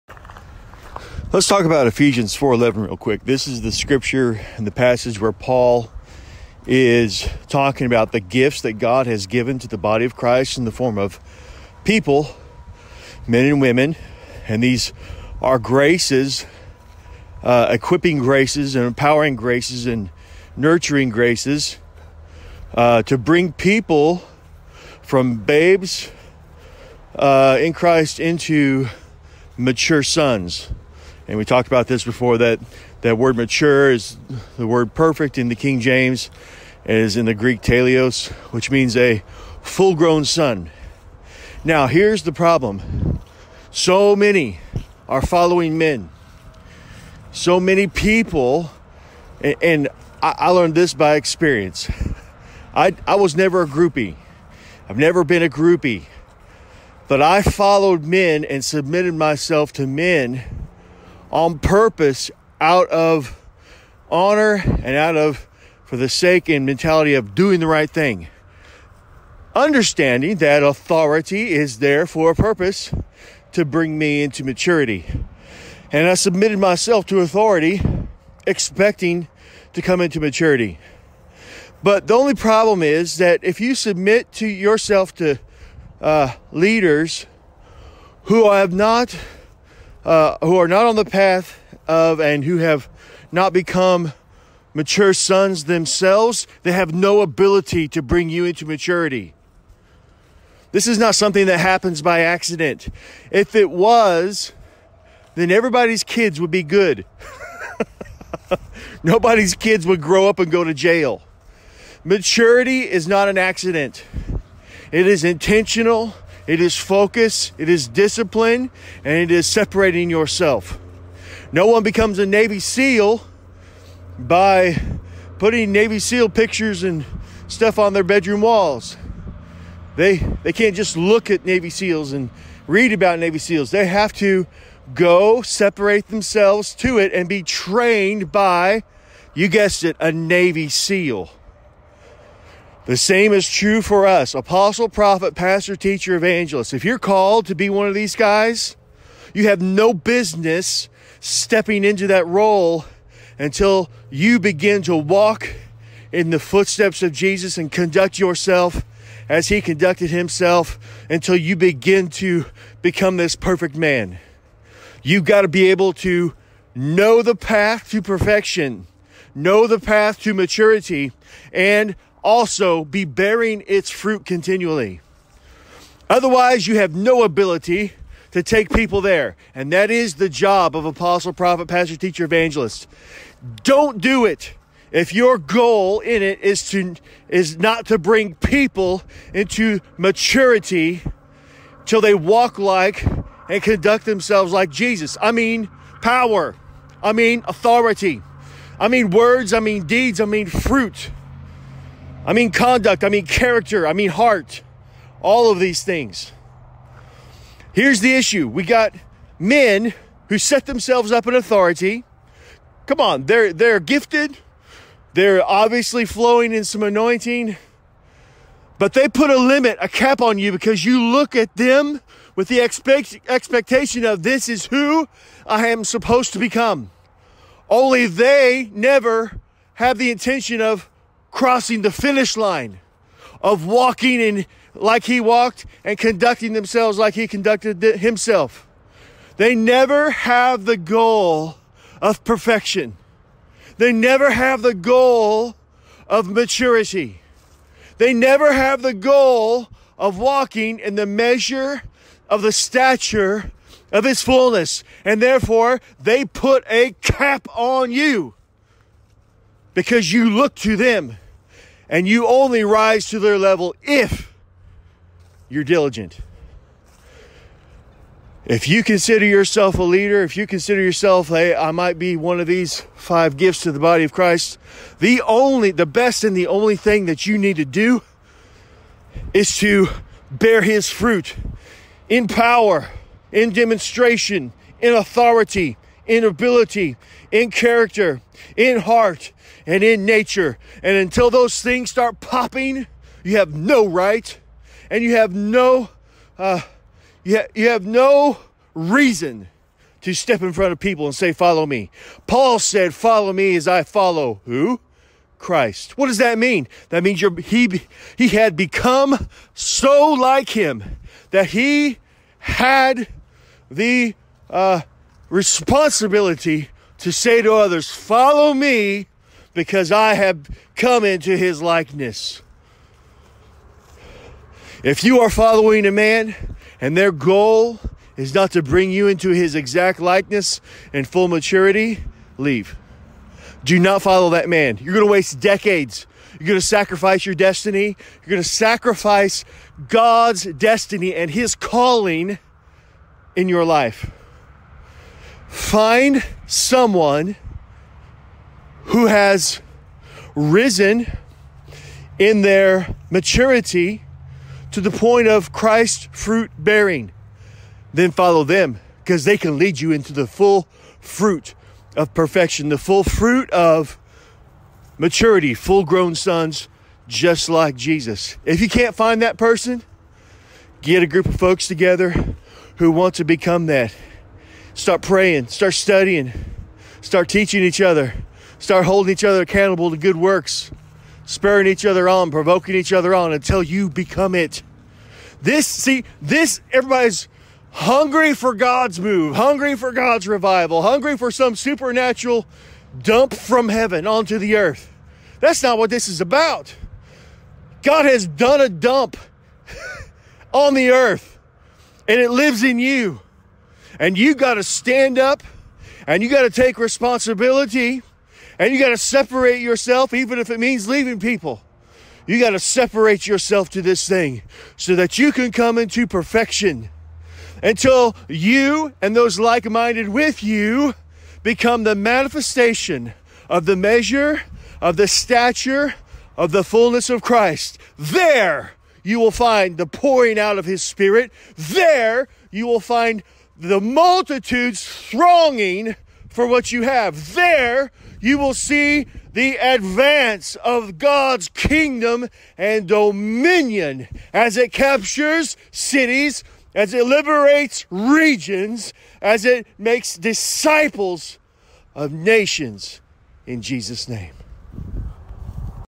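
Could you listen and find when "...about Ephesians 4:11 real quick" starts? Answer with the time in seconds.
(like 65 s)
1 s.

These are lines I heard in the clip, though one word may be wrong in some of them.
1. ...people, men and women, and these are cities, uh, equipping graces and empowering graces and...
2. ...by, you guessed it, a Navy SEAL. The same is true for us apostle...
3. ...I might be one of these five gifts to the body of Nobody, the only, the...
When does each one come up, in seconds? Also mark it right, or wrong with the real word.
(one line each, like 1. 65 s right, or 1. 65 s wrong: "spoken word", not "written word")
1. 11 s wrong: "graces", not "cities"
2. 138 s right
3. 271 s wrong: "Christ", not "Nobody".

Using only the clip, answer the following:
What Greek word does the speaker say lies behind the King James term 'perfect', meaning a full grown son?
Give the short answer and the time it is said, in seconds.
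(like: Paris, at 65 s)
teleos, at 37 s.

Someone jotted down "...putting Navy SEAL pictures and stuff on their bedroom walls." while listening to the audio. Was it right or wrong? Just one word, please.
right.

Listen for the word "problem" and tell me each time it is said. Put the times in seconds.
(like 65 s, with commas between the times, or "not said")
42 s, 82 s.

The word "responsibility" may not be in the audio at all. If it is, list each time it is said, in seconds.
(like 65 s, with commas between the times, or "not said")
315 s, 406 s.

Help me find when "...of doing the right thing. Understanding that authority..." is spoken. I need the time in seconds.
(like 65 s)
67 s.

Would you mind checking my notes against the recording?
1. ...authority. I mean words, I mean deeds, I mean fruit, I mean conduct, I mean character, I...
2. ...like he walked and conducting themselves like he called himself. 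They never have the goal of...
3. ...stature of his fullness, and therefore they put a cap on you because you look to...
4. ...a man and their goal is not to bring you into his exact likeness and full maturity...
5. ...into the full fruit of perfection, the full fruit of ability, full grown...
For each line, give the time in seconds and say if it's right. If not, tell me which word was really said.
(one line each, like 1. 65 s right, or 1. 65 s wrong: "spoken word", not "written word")
1. 197 s right
2. 234 s wrong: "conducted", not "called"
3. 252 s right
4. 325 s right
5. 359 s wrong: "maturity", not "ability".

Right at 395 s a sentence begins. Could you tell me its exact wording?
That's not what this is about.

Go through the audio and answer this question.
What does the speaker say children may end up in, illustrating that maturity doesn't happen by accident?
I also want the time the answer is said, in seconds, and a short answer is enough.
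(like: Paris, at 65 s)
jail, at 110 s.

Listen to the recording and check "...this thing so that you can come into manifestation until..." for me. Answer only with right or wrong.
wrong.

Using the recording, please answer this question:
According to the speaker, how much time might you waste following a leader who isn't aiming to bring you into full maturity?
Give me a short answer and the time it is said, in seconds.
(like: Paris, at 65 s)
decades, at 335 s.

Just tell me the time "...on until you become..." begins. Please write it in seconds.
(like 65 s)
383 s.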